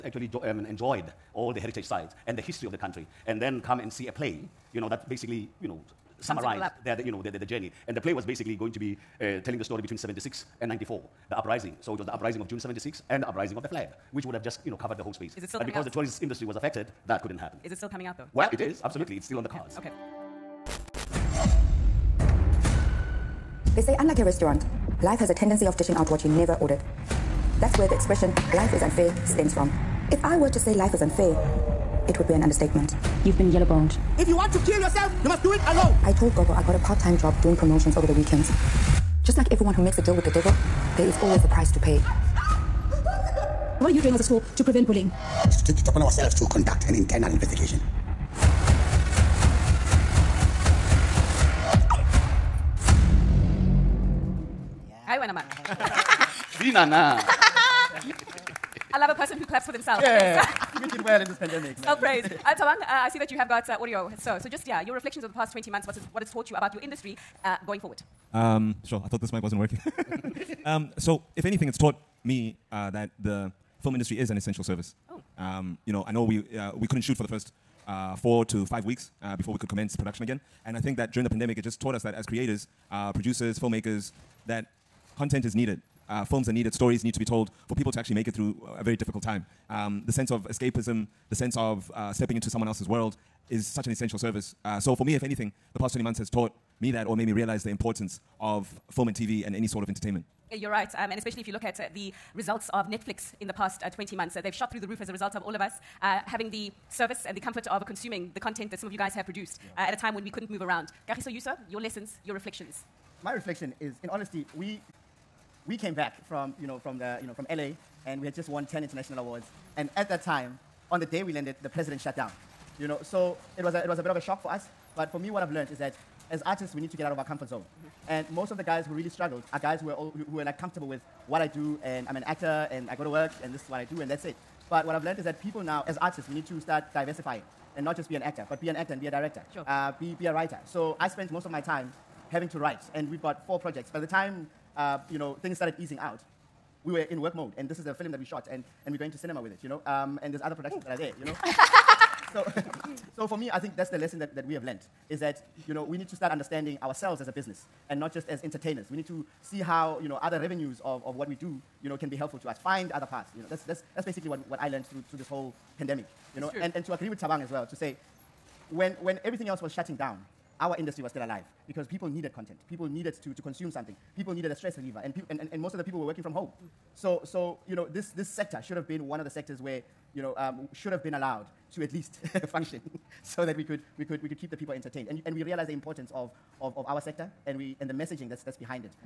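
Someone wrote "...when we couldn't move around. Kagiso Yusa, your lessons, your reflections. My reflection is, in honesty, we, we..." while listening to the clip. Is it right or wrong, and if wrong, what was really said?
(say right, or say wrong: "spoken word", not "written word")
right.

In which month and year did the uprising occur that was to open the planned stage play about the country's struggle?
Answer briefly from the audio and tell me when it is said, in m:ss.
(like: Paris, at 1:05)
June 1976, at 0:12.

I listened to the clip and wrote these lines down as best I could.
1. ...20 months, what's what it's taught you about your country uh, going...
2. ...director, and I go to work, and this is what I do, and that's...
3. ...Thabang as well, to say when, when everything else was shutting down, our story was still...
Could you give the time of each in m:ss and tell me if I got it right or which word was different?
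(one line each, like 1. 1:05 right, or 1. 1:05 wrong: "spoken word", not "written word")
1. 1:05 wrong: "industry", not "country"
2. 2:12 wrong: "actor", not "director"
3. 2:47 wrong: "industry", not "story".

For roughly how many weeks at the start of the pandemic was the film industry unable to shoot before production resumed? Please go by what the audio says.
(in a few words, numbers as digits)
4 to 5 weeks.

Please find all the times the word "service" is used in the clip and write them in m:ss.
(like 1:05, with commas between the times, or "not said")
1:14, 1:34, 1:46.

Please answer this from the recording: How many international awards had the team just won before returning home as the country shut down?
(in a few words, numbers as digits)
10.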